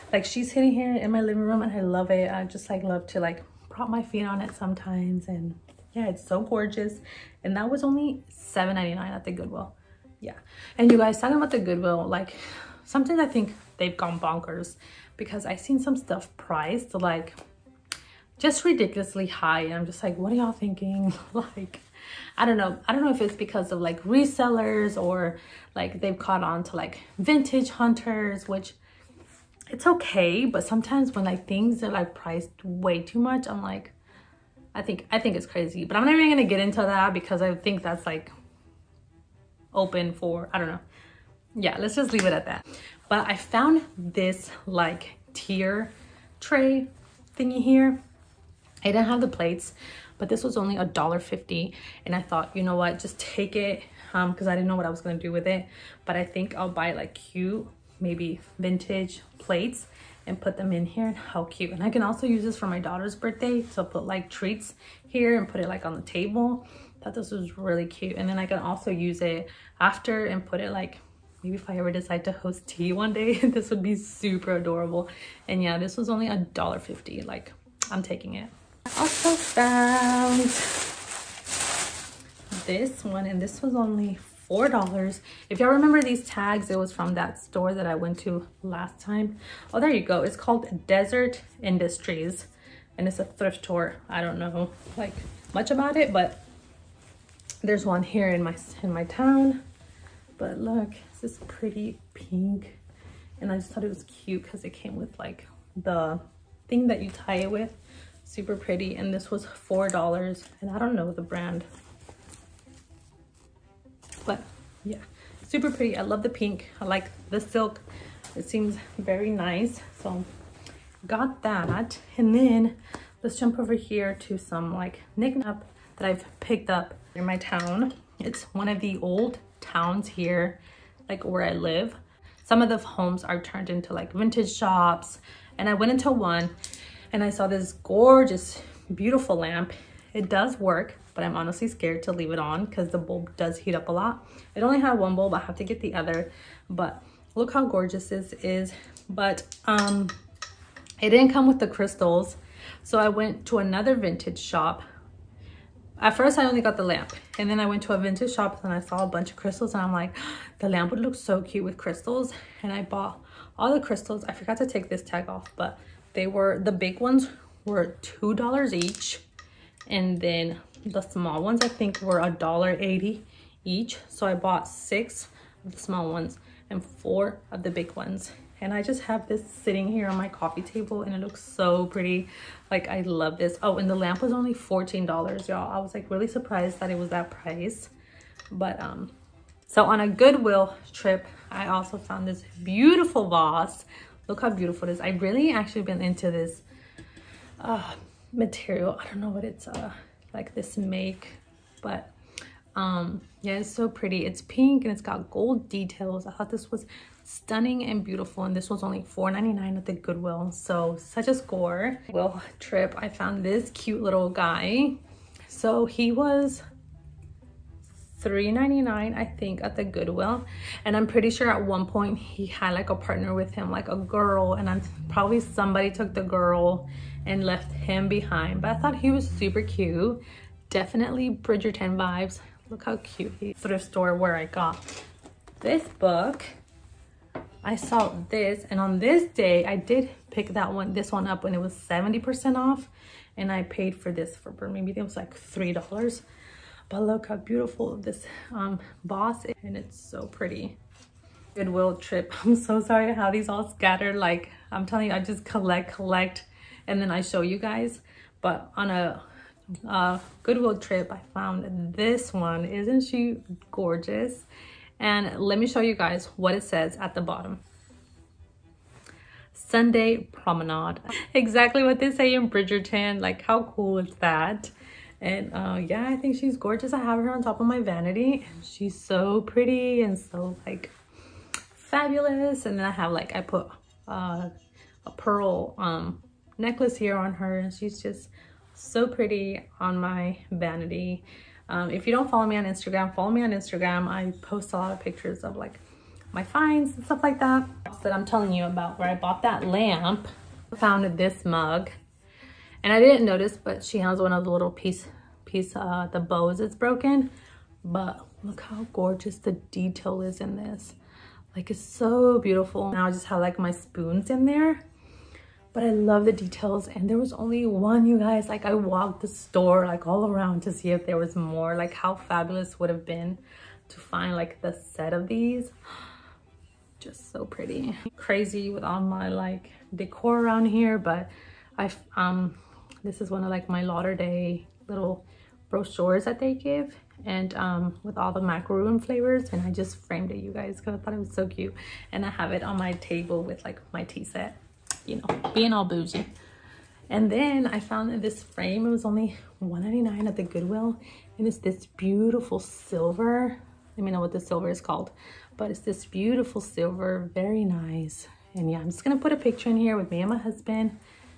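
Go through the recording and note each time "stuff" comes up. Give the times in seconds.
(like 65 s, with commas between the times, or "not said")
15 s, 297 s.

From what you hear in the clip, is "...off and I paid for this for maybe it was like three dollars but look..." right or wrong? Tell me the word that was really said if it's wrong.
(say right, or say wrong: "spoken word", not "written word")
right.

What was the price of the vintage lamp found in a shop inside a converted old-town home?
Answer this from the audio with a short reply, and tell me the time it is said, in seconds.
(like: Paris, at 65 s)
$14, at 184 s.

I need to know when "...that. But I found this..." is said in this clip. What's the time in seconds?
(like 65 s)
42 s.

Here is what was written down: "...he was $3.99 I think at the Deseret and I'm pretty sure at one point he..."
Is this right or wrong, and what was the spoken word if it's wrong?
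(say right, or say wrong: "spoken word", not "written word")
wrong: "Goodwill", not "Deseret".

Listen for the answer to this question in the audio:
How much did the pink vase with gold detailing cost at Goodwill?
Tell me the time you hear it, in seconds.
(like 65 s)
209 s.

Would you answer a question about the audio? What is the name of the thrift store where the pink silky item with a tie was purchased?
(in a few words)
Deseret Industries.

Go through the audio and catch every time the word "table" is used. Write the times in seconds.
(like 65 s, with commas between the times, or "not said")
66 s, 180 s, 342 s.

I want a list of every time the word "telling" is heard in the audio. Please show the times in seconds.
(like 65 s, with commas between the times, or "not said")
254 s, 298 s.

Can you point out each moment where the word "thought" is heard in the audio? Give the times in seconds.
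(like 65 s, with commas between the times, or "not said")
52 s, 67 s, 103 s, 206 s, 228 s, 340 s.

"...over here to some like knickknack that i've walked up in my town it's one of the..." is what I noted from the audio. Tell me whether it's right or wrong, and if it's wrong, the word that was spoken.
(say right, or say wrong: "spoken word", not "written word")
wrong: "picked", not "walked".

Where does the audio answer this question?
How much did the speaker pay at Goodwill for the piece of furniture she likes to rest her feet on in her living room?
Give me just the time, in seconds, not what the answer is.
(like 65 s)
8 s.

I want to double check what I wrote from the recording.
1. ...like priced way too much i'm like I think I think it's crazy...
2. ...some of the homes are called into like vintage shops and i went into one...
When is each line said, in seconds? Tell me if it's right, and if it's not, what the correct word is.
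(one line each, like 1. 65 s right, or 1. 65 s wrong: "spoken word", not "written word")
1. 31 s right
2. 132 s wrong: "turned", not "called".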